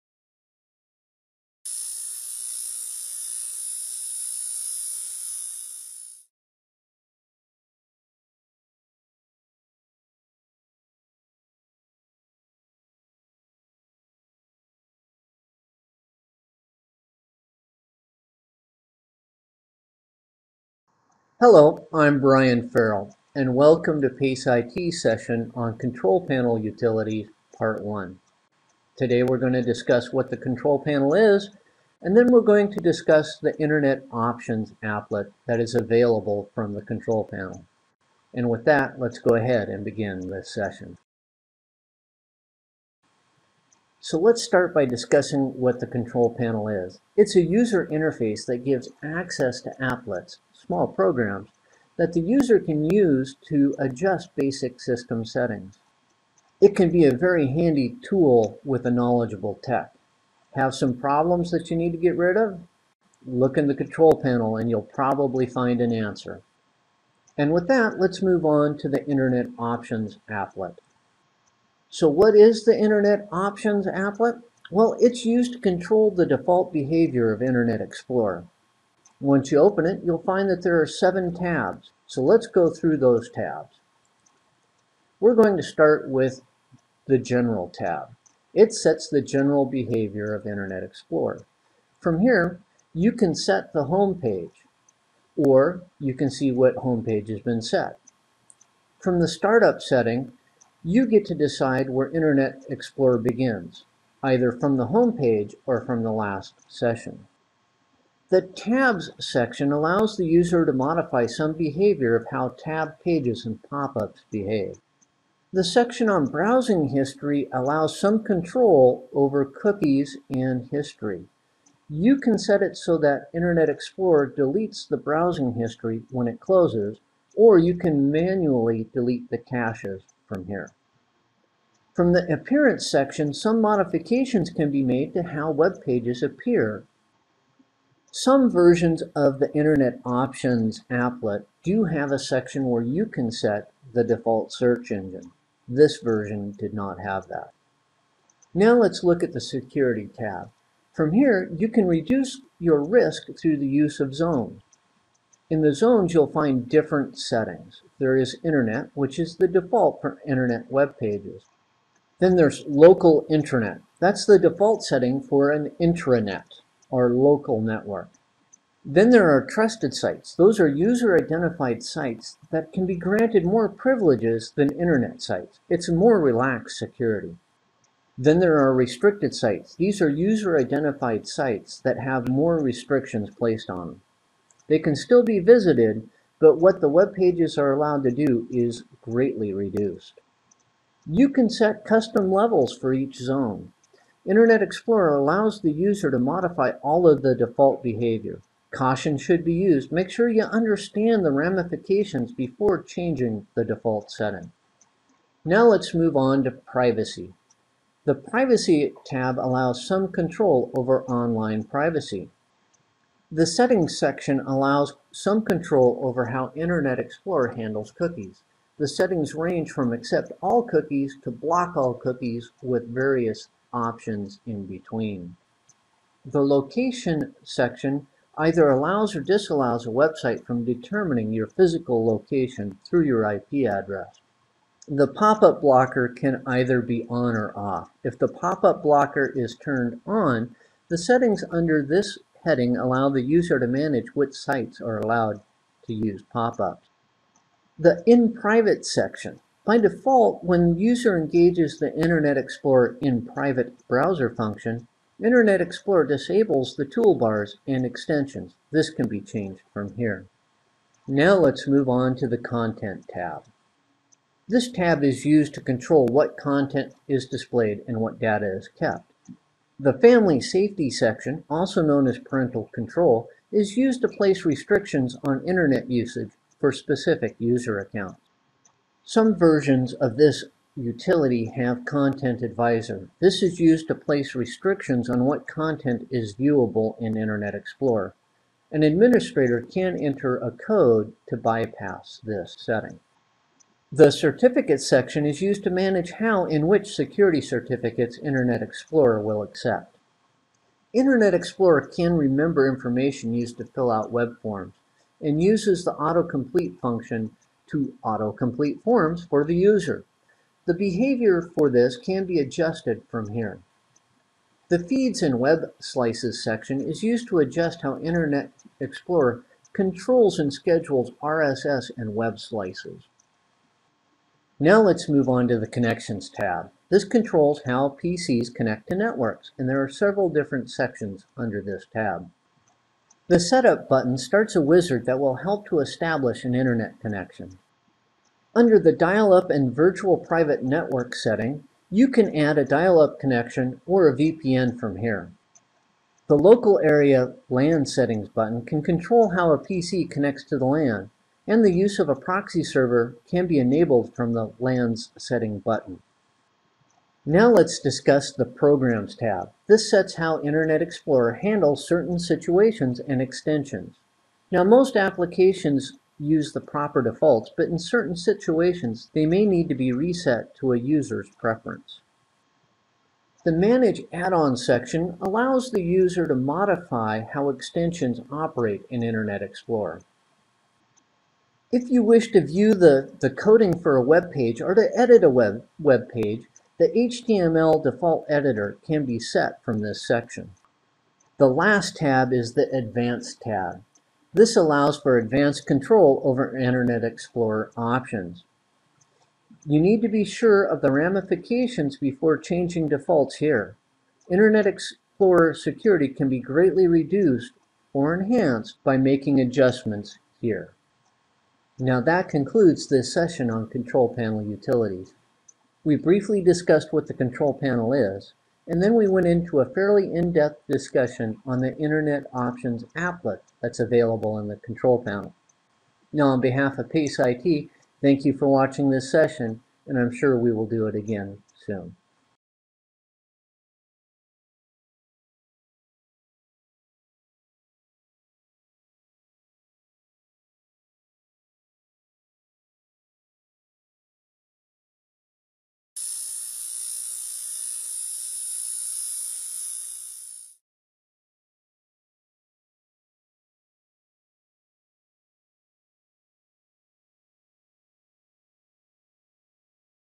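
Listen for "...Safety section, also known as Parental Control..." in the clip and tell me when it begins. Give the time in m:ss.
4:30.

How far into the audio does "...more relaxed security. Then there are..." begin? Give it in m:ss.
2:55.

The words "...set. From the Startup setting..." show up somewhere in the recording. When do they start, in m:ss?
1:37.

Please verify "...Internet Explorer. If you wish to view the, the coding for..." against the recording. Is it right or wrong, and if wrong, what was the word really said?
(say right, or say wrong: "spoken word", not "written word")
right.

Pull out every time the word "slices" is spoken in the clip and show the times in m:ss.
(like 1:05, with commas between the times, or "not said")
5:15, 5:22.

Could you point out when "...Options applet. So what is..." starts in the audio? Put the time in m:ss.
1:09.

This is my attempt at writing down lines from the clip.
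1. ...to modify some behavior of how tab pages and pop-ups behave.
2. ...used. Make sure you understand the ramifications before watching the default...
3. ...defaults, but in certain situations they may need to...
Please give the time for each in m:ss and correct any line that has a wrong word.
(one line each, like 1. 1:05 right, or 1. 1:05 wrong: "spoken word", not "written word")
1. 1:50 right
2. 3:19 wrong: "changing", not "watching"
3. 6:07 right.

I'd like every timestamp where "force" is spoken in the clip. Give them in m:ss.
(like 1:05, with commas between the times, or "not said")
not said.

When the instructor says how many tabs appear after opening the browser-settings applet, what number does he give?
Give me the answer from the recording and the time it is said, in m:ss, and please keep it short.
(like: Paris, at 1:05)
7, at 1:20.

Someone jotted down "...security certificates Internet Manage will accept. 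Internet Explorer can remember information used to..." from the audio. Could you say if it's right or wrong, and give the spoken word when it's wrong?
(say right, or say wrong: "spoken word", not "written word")
wrong: "Explorer", not "Manage".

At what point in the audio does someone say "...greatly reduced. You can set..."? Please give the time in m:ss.
3:09.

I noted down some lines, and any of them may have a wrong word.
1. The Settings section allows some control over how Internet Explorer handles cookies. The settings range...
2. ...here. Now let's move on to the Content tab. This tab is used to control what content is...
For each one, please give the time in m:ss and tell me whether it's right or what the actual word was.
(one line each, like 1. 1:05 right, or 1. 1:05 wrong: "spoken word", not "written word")
1. 3:33 right
2. 4:19 right.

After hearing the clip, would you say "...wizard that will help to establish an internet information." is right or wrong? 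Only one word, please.
wrong.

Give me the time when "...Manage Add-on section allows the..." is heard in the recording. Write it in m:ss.
6:13.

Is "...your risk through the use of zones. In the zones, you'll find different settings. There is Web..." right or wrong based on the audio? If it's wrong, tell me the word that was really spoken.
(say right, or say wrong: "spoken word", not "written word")
wrong: "Internet", not "Web".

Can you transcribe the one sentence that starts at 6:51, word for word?
Now that concludes this session on Control Panel Utilities.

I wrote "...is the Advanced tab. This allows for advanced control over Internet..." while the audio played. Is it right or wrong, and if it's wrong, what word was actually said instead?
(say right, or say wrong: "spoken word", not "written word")
right.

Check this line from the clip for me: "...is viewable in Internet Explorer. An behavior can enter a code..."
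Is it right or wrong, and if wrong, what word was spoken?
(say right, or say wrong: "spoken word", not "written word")
wrong: "administrator", not "behavior".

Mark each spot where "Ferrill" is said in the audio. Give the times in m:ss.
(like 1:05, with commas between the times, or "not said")
0:22.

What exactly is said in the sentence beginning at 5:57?
Now let's discuss the Programs tab.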